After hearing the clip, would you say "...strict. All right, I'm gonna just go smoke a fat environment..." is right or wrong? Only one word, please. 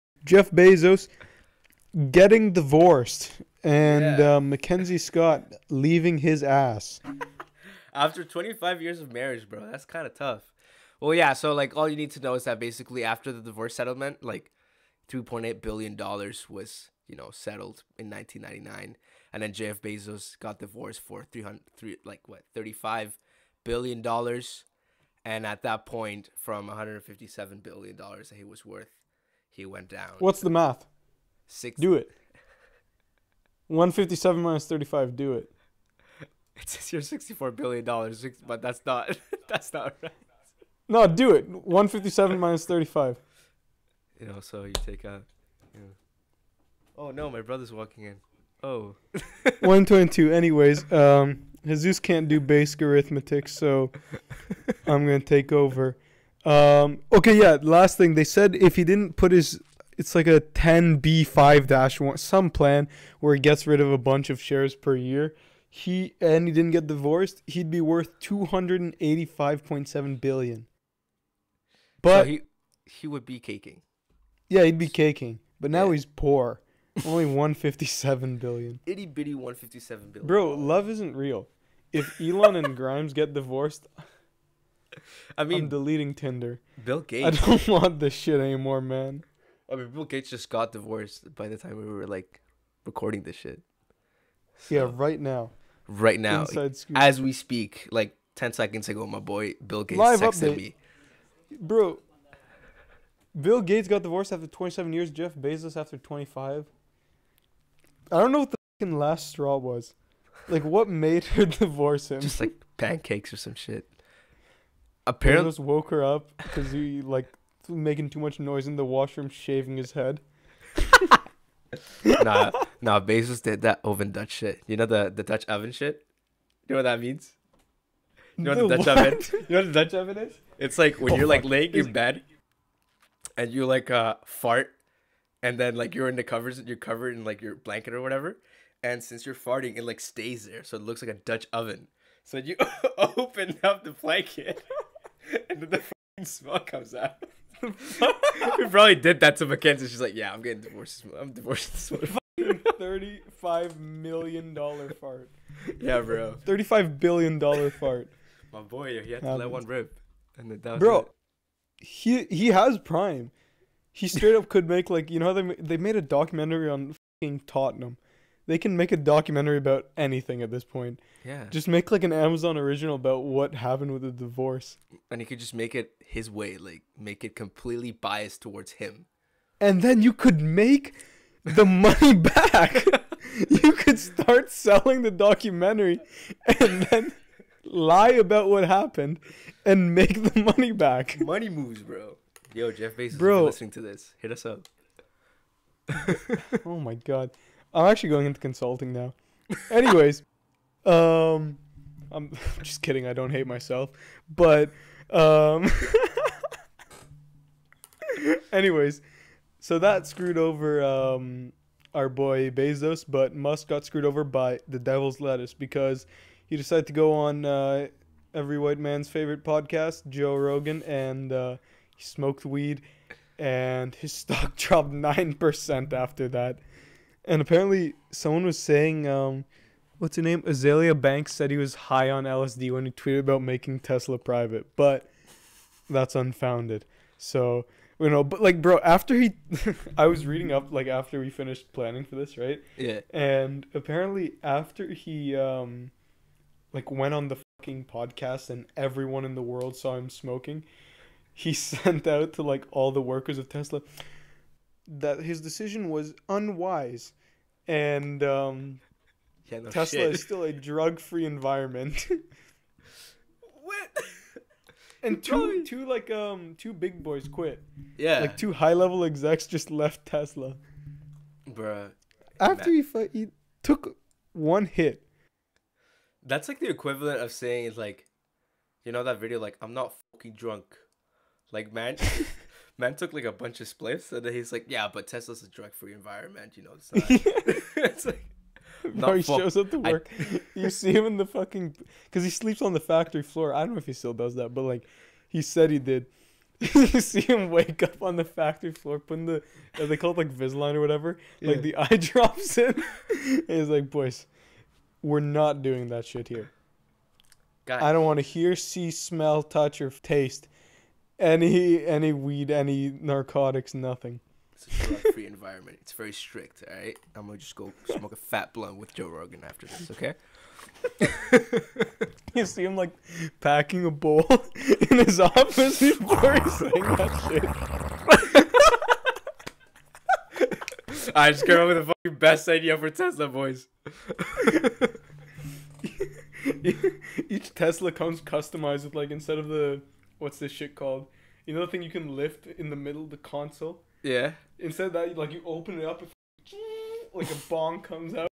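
wrong.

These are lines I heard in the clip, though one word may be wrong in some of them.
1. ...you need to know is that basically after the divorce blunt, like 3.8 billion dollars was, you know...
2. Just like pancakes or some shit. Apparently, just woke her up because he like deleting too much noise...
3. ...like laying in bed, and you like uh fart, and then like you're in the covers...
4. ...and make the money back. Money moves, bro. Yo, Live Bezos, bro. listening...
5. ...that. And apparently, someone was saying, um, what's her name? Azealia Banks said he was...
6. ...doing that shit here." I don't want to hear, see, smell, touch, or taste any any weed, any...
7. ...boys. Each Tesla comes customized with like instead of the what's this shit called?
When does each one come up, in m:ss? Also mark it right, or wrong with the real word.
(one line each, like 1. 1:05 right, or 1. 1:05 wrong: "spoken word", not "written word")
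1. 0:11 wrong: "settlement", not "blunt"
2. 1:52 wrong: "making", not "deleting"
3. 2:11 right
4. 3:09 wrong: "Jeff", not "Live"
5. 3:46 right
6. 5:05 right
7. 5:33 right.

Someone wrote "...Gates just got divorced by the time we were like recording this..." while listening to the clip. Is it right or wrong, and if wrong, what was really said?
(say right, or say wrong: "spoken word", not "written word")
right.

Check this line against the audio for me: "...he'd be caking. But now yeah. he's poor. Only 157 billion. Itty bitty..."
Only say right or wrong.
right.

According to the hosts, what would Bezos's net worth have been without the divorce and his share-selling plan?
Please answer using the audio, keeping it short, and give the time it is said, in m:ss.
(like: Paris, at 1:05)
$285.7 billion, at 1:08.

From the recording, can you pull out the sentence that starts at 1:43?
Bill Gates got divorced after 27 years.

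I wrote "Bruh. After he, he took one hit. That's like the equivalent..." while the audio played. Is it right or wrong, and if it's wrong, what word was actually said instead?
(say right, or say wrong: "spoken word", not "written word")
right.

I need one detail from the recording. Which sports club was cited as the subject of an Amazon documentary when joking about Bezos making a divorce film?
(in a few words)
Tottenham.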